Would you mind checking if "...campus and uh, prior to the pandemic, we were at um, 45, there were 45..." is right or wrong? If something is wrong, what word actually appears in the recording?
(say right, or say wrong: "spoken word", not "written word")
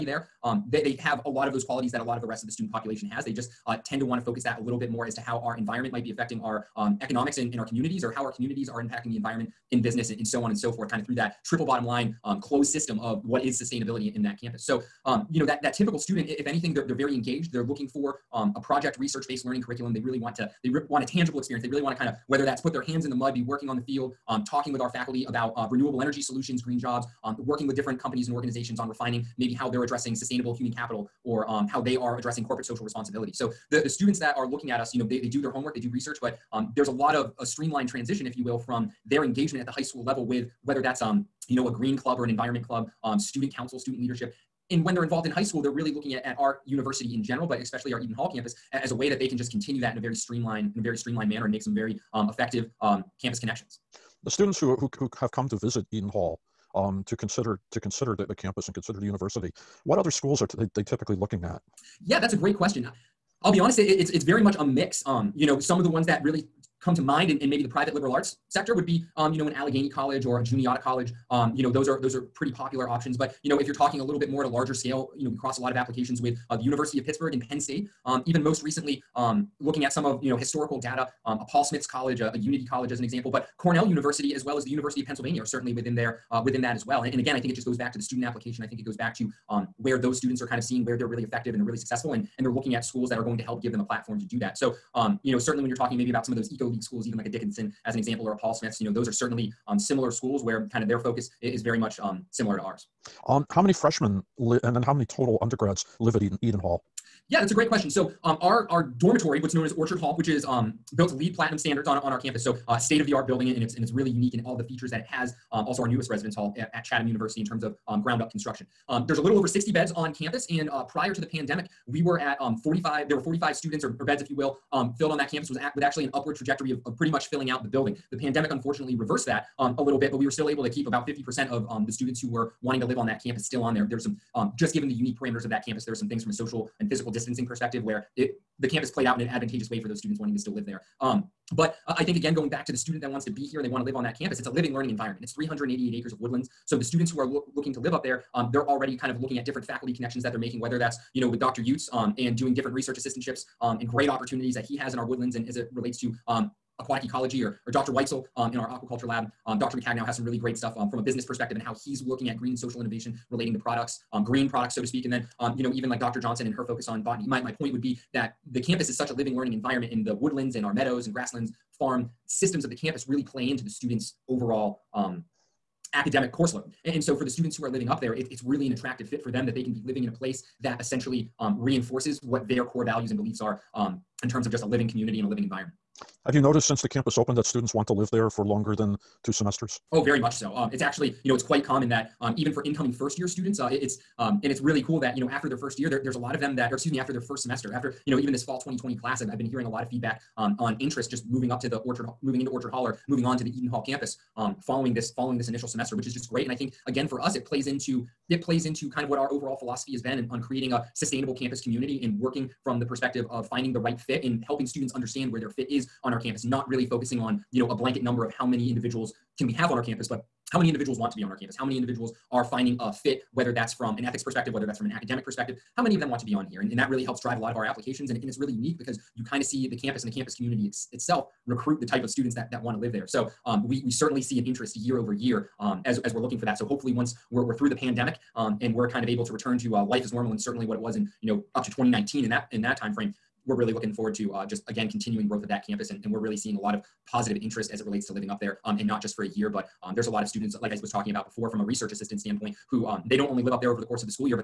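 right.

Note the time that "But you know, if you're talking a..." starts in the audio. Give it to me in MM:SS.
01:13.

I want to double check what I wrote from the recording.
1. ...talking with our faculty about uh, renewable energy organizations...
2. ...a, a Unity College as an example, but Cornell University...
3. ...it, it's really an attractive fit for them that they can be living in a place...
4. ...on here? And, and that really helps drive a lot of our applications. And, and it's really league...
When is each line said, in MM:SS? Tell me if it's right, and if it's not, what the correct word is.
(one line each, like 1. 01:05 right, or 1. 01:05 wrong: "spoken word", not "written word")
1. 00:24 wrong: "solutions", not "organizations"
2. 01:22 right
3. 02:58 right
4. 03:46 wrong: "unique", not "league".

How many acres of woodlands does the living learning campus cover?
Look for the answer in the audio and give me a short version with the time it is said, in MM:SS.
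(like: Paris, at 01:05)
388, at 02:25.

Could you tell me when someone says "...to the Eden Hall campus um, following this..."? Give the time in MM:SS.
03:23.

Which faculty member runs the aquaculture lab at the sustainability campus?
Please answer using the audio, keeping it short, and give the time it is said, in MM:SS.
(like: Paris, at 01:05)
Dr. Weitzel, at 02:37.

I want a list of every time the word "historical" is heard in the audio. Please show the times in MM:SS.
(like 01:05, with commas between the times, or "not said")
01:20.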